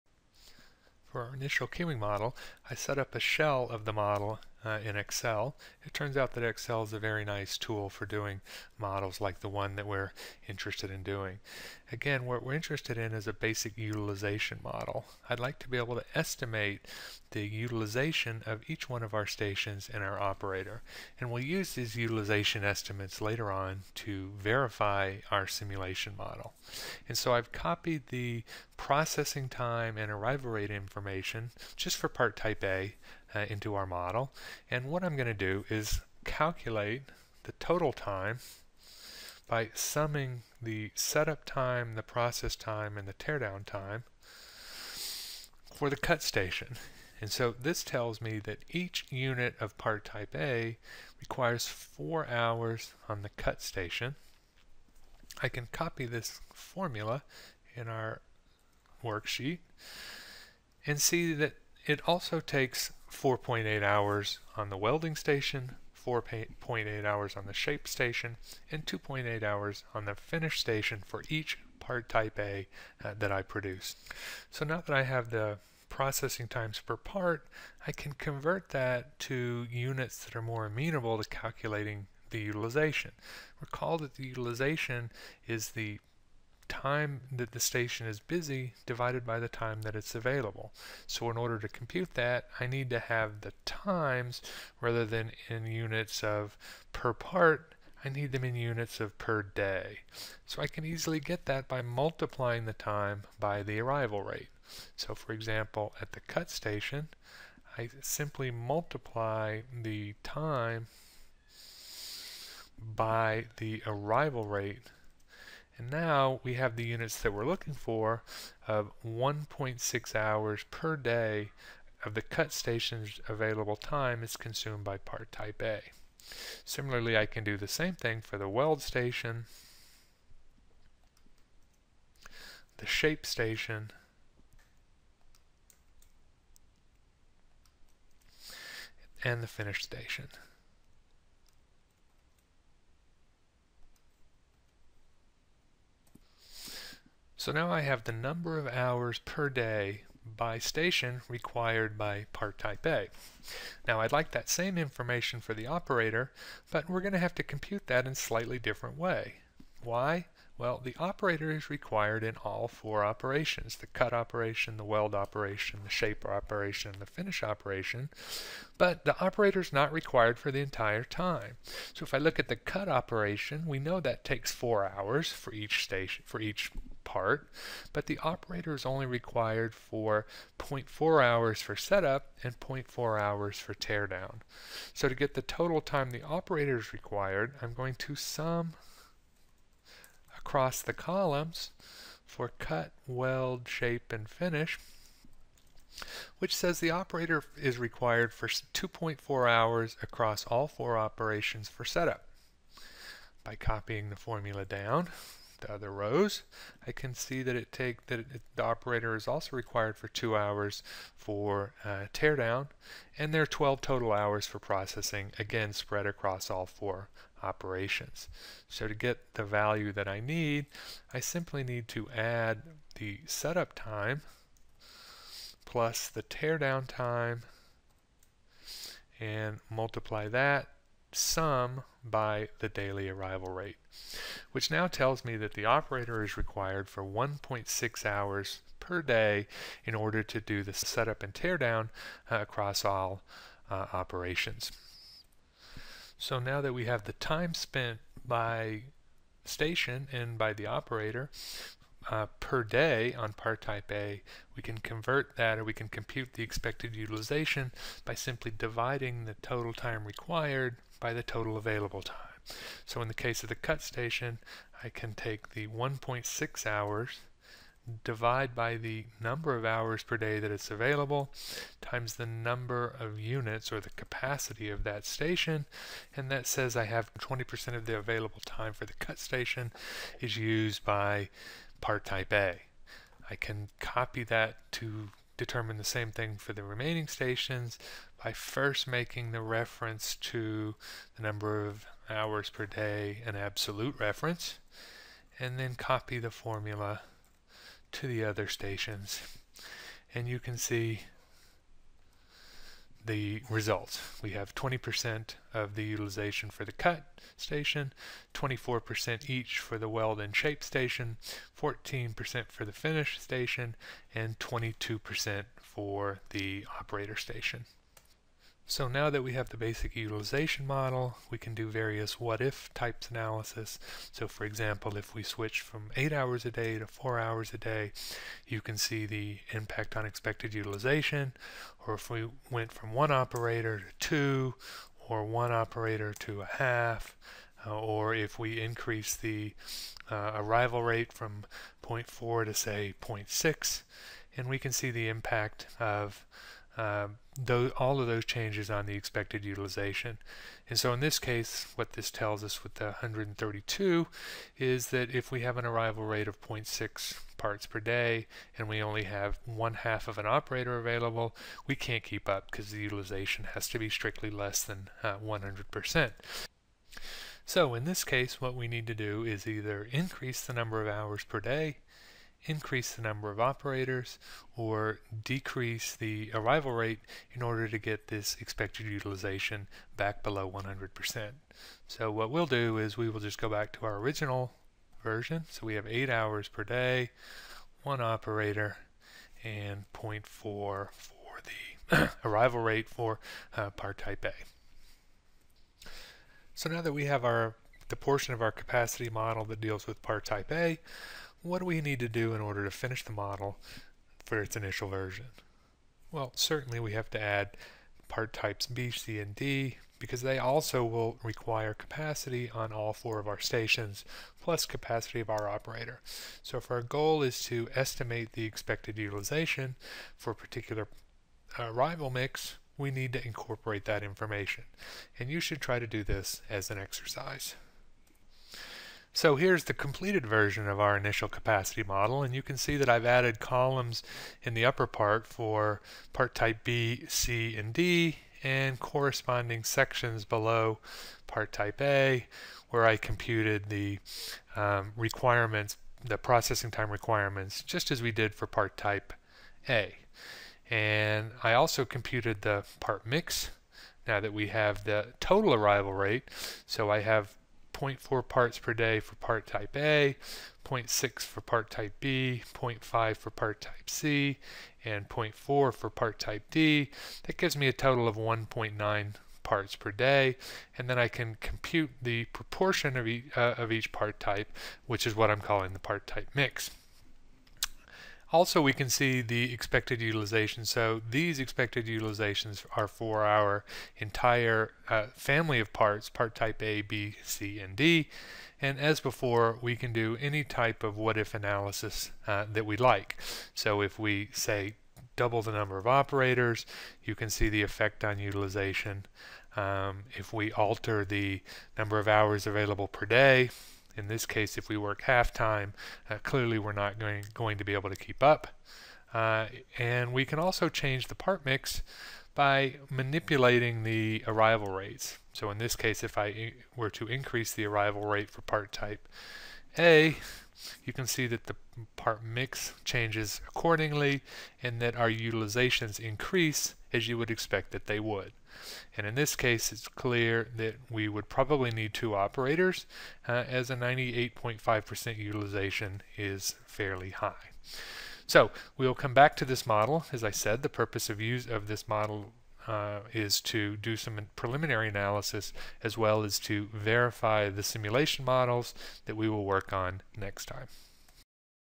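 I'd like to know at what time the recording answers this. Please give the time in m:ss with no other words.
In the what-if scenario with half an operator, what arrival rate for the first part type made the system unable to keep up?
5:56.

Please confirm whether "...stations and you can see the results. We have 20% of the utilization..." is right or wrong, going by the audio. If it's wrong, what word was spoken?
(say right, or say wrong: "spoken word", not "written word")
right.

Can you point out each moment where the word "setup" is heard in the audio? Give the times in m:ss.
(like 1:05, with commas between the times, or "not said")
0:40, 3:01, 3:21, 3:43, 4:00.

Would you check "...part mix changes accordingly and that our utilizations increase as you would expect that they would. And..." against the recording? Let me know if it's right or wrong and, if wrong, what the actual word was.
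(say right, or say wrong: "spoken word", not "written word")
right.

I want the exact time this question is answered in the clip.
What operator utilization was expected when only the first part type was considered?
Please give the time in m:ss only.
5:14.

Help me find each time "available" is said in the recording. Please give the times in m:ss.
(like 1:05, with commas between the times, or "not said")
1:30, 2:03, 4:21, 4:30, 4:37, 6:00, 8:22.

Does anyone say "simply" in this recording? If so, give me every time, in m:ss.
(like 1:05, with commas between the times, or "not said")
1:48, 3:41, 4:18.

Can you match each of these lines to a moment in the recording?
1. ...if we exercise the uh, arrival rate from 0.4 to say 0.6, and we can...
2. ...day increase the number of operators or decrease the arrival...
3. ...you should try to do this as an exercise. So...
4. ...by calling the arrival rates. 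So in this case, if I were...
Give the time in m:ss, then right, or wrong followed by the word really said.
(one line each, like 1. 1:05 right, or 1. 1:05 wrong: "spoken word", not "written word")
1. 5:38 wrong: "increase", not "exercise"
2. 6:11 right
3. 7:05 right
4. 8:32 wrong: "manipulating", not "calling".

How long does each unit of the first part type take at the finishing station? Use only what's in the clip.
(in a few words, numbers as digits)
2.8 hours.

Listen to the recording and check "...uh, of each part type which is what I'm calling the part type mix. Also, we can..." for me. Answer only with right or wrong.
right.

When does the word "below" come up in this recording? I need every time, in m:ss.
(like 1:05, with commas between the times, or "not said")
6:20, 7:20.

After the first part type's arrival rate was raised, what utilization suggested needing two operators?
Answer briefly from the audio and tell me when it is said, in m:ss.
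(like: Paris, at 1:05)
98.5%, at 8:53.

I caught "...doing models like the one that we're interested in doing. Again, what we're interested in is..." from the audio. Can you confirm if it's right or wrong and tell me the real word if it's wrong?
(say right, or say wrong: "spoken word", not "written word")
right.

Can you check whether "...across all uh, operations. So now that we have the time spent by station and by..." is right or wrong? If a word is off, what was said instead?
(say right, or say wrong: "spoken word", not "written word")
right.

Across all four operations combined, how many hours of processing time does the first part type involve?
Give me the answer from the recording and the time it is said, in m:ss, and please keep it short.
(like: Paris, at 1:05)
12, at 3:33.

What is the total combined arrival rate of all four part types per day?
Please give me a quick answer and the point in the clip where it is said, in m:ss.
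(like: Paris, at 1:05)
1.9 parts per day, at 7:48.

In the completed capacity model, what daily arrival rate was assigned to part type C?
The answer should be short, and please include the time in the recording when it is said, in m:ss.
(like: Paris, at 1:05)
0.5, at 7:42.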